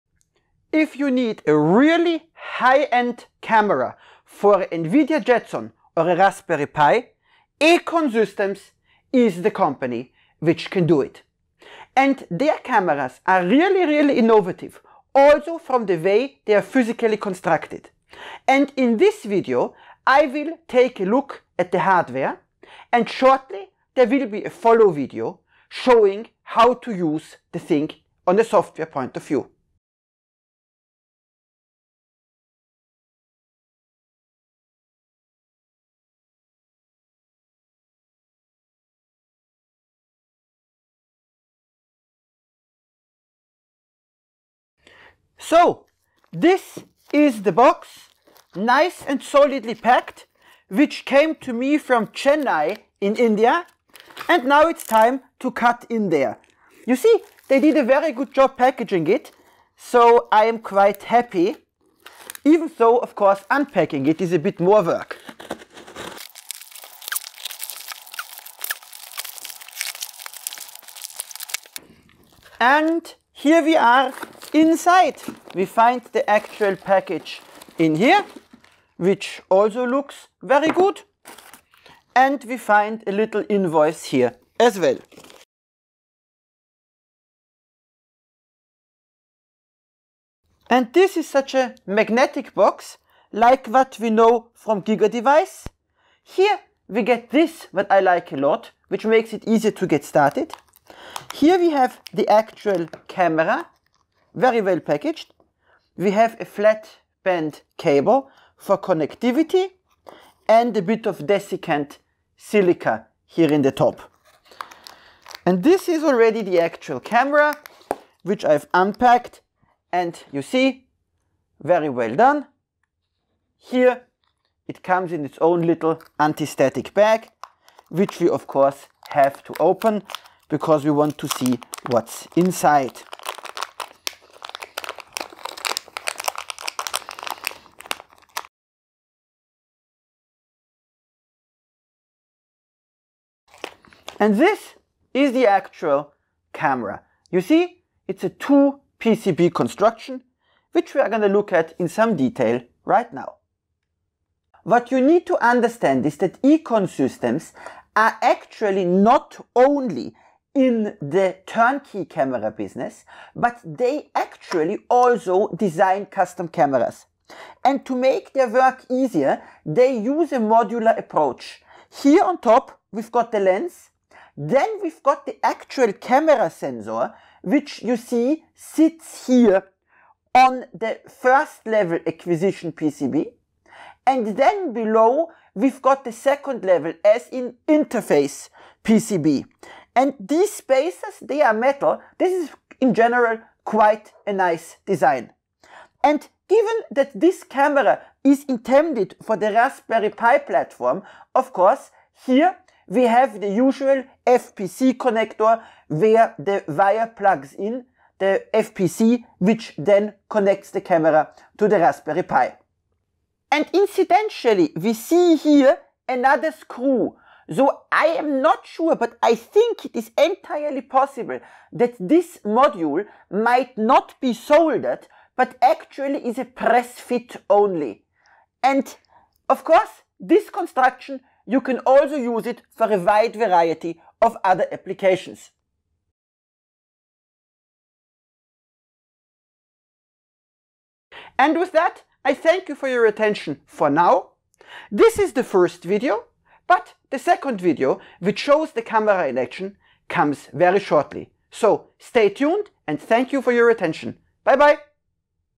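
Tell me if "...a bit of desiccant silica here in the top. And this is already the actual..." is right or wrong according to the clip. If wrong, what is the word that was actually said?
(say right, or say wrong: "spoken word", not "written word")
right.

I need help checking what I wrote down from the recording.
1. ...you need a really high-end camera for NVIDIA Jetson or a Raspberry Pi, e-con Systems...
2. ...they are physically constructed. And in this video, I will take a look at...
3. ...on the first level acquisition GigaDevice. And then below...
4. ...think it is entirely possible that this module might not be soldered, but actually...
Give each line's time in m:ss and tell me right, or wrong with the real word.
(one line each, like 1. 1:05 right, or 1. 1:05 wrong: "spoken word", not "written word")
1. 0:00 right
2. 0:16 right
3. 3:00 wrong: "PCB", not "GigaDevice"
4. 3:39 right.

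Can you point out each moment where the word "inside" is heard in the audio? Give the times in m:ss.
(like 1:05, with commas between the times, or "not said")
1:14, 2:12.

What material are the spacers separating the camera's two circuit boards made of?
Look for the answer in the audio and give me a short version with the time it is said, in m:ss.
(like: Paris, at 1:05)
Metal, at 3:11.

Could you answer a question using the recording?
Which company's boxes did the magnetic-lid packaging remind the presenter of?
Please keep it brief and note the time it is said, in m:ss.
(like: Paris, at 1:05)
GigaDevice, at 1:34.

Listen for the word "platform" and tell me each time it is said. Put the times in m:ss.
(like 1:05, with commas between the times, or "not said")
3:20.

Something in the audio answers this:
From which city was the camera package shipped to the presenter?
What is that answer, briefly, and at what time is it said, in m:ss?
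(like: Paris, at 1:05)
Chennai, at 0:52.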